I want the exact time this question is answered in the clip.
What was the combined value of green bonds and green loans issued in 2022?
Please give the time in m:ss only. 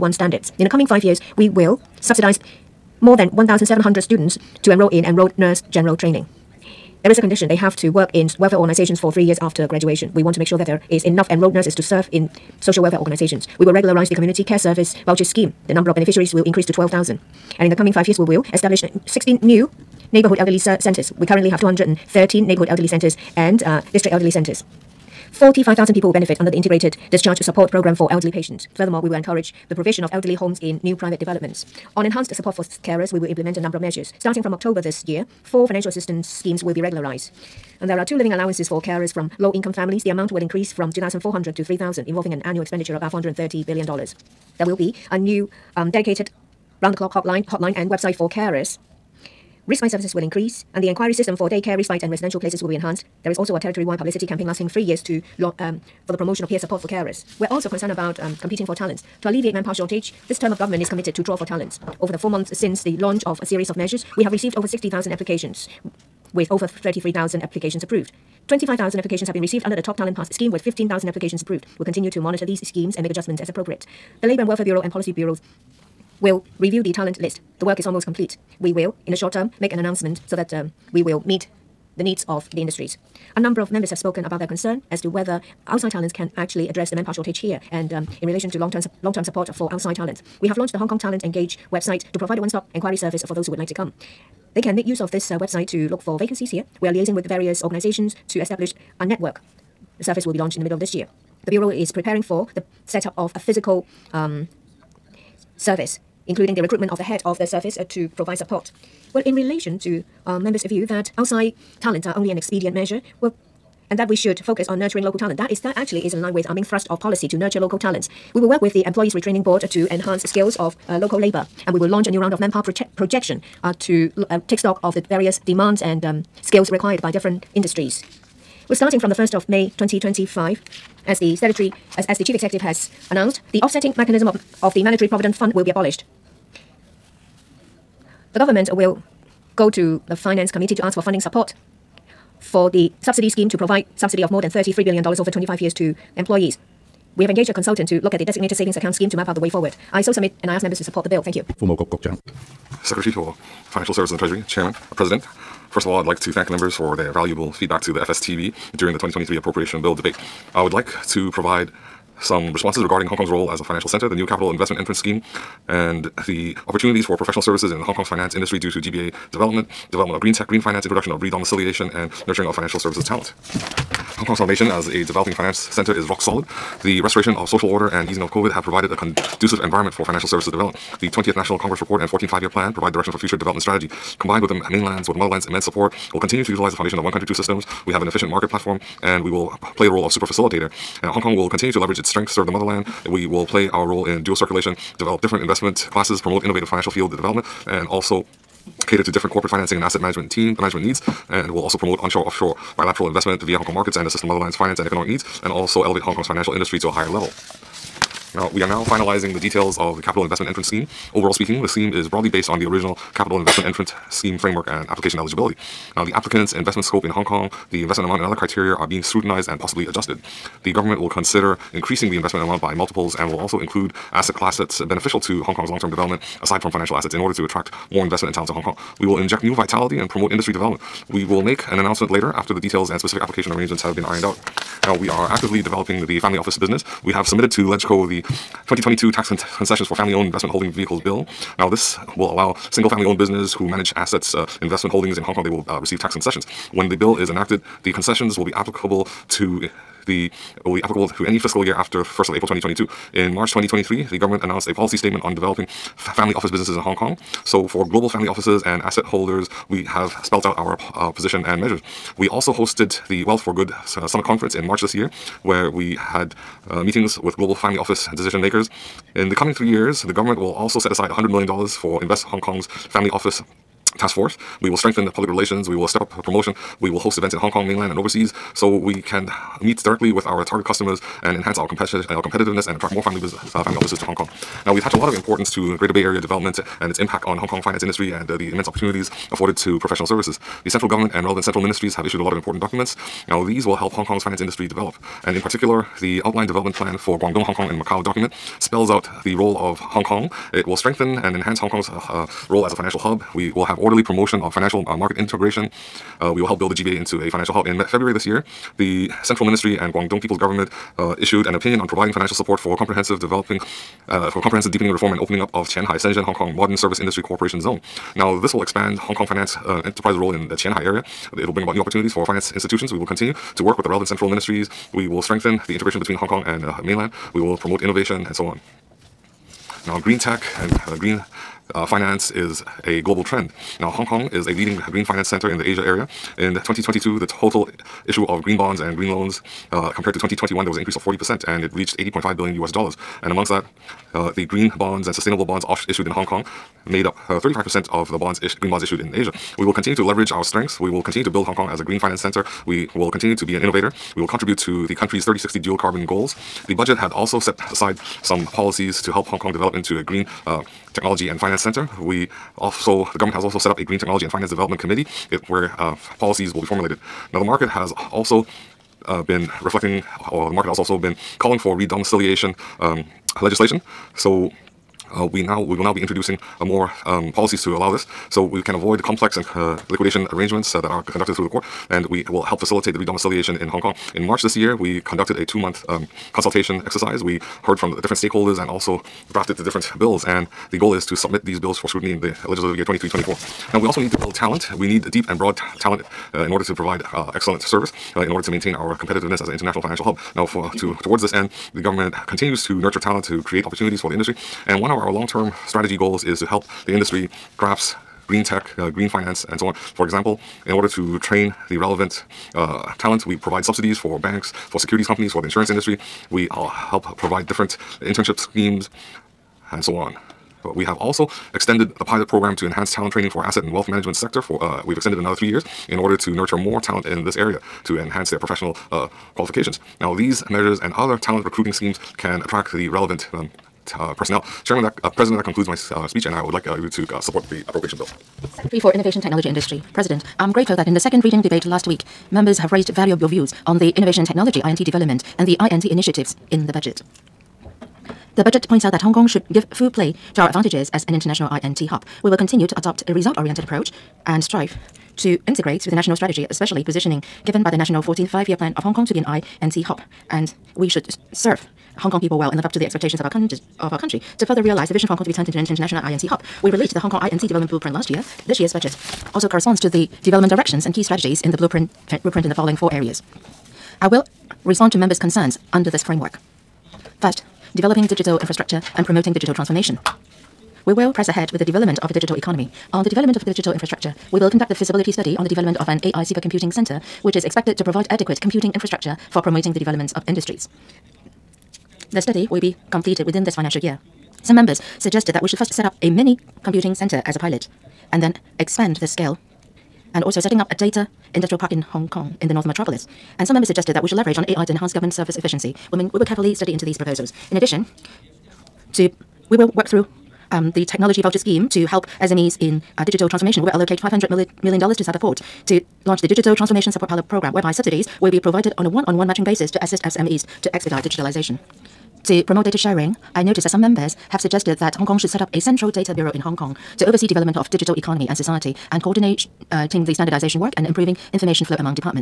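5:41.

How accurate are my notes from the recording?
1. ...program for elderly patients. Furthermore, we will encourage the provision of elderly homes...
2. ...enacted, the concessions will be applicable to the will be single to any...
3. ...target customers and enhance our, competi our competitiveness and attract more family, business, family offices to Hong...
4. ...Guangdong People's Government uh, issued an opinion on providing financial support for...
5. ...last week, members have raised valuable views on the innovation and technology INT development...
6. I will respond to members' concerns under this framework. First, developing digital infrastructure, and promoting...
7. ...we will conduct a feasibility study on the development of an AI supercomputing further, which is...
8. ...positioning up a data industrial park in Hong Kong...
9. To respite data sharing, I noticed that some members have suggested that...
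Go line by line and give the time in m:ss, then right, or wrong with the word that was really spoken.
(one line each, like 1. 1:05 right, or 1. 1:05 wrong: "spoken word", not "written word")
1. 0:27 right
2. 4:07 wrong: "applicable", not "single"
3. 4:40 right
4. 5:09 right
5. 7:21 right
6. 7:54 right
7. 8:04 wrong: "center", not "further"
8. 8:20 wrong: "setting", not "positioning"
9. 8:42 wrong: "promote", not "respite".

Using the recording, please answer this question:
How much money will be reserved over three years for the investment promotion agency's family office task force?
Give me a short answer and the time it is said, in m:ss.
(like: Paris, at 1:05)
$100 million, at 4:31.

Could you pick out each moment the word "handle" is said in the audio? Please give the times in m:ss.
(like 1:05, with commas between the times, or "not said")
not said.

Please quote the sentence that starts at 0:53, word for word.
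There is also a territory-wide publicity campaign lasting three years to um, for the promotion of peer support for carers.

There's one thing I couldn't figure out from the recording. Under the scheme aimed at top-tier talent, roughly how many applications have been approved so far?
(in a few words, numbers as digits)
15,000.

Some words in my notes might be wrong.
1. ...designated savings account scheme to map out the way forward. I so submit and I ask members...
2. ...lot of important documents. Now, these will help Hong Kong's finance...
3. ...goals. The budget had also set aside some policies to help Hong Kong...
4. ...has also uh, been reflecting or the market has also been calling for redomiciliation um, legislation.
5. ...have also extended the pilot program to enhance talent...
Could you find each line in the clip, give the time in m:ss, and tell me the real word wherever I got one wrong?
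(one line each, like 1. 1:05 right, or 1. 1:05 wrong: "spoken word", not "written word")
1. 2:28 right
2. 4:52 right
3. 5:56 right
4. 6:07 right
5. 7:00 right.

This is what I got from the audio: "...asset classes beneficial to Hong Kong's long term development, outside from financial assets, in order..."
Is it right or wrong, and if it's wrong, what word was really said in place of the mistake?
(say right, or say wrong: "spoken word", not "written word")
wrong: "aside", not "outside".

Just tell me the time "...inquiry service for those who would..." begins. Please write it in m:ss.
1:32.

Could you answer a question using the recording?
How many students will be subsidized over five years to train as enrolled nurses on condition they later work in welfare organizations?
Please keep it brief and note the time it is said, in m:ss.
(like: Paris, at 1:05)
1,700, at 0:03.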